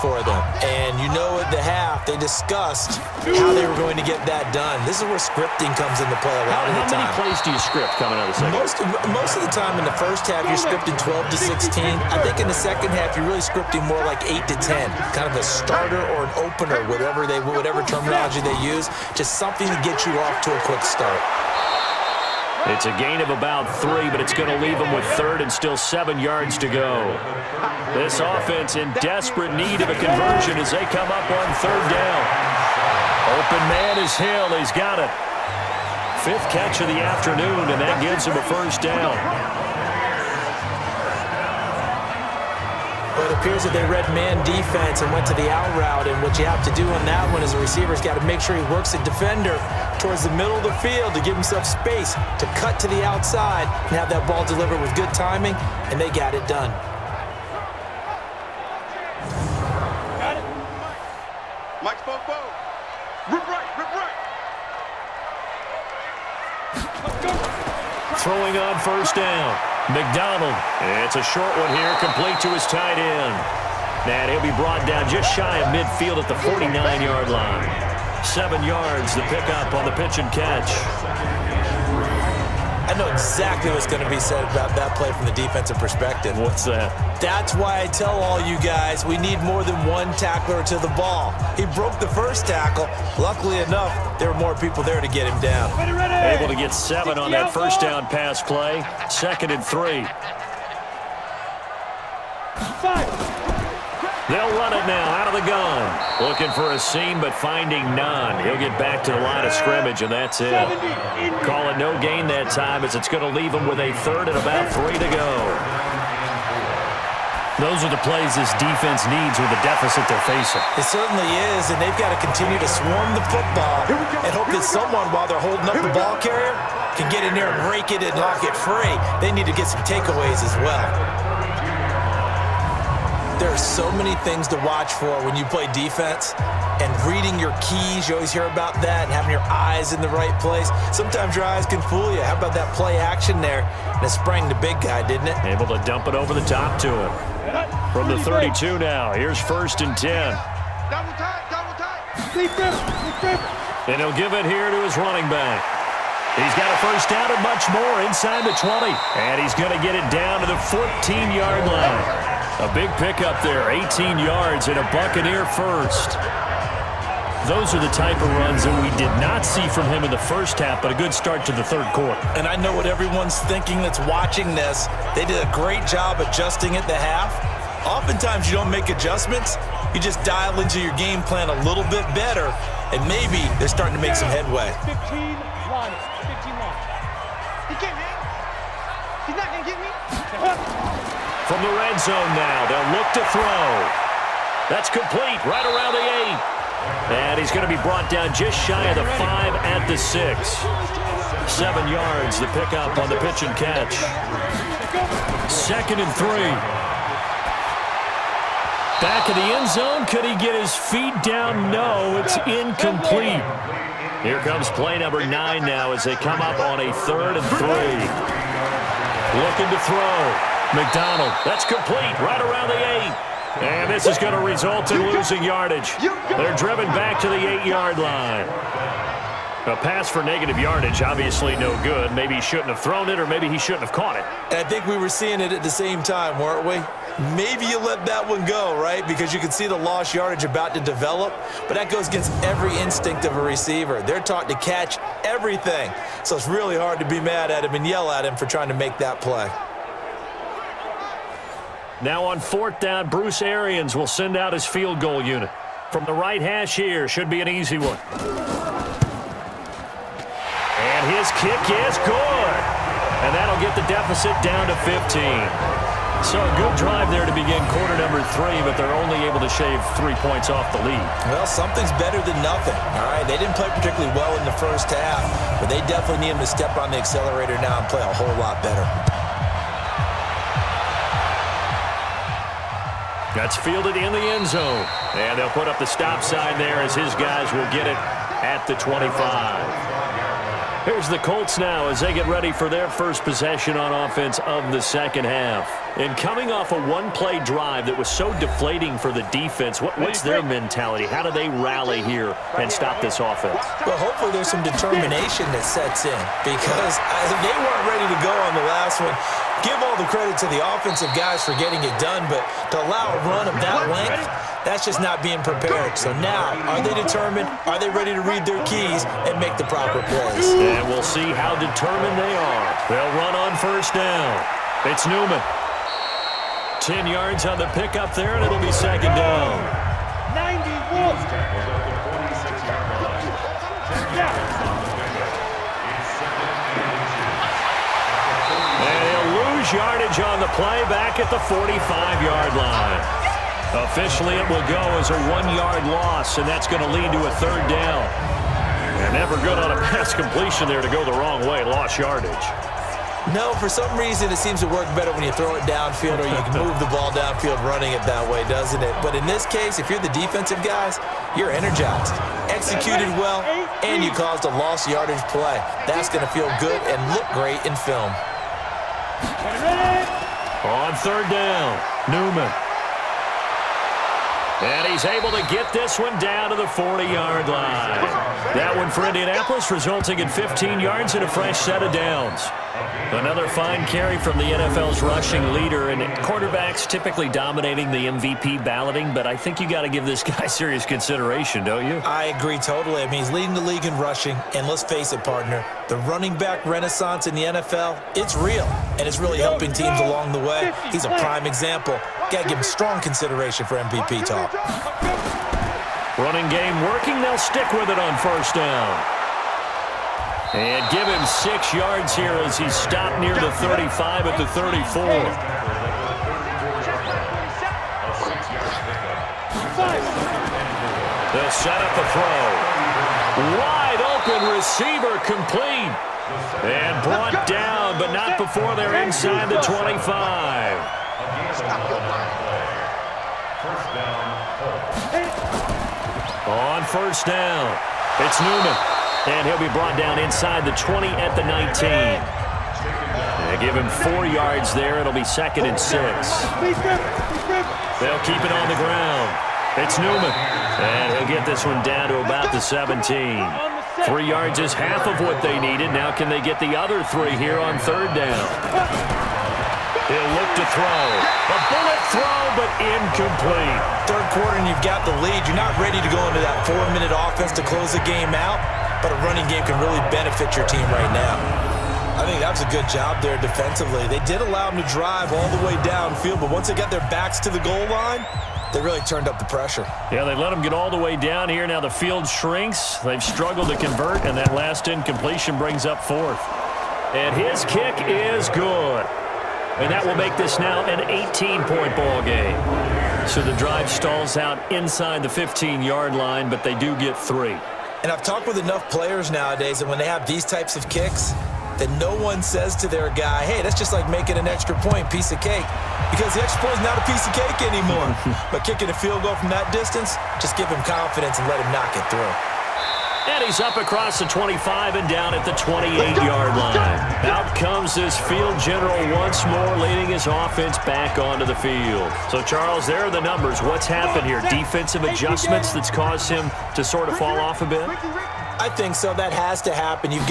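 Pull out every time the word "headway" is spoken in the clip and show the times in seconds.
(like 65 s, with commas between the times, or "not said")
184 s.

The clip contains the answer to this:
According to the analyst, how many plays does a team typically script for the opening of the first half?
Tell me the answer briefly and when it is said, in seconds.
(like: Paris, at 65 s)
12 to 16, at 10 s.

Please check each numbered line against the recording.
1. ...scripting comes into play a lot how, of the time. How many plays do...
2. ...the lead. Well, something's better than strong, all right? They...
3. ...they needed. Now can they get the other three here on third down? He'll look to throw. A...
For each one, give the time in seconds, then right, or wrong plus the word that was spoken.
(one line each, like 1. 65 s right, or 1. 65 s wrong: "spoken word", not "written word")
1. 5 s right
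2. 270 s wrong: "nothing", not "strong"
3. 455 s right.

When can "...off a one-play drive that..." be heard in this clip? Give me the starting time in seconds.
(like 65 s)
296 s.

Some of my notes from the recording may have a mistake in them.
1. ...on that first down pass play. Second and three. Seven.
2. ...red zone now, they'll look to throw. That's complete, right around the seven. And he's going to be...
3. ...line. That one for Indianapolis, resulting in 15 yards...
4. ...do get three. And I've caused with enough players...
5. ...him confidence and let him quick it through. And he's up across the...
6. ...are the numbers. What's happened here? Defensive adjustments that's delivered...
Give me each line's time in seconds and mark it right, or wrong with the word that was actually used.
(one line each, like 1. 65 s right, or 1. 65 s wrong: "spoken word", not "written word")
1. 97 s wrong: "Five", not "Seven"
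2. 191 s wrong: "eight", not "seven"
3. 377 s right
4. 496 s wrong: "talked", not "caused"
5. 510 s wrong: "knock", not "quick"
6. 523 s wrong: "caused", not "delivered".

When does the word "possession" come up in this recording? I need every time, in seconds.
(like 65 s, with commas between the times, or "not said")
293 s.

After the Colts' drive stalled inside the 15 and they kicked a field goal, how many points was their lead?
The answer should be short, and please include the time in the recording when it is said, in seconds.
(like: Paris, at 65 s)
18, at 491 s.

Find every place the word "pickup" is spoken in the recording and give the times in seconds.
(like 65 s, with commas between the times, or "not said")
79 s, 162 s, 202 s, 327 s.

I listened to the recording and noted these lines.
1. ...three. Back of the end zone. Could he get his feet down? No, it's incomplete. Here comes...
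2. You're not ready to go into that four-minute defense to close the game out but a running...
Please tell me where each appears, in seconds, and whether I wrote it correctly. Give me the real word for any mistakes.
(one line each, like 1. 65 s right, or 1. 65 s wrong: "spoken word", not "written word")
1. 206 s right
2. 465 s wrong: "offense", not "defense".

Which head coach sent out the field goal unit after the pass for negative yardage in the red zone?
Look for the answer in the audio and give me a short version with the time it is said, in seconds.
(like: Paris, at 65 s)
Bruce Arians, at 253 s.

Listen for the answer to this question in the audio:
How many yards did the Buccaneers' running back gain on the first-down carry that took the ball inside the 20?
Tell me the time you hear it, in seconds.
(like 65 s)
163 s.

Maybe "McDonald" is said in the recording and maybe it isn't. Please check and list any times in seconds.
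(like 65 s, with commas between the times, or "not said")
69 s, 220 s.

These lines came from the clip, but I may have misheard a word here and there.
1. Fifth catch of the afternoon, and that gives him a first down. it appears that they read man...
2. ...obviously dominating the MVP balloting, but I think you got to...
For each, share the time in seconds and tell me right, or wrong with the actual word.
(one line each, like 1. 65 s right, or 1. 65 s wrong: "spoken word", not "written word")
1. 36 s right
2. 386 s wrong: "typically", not "obviously".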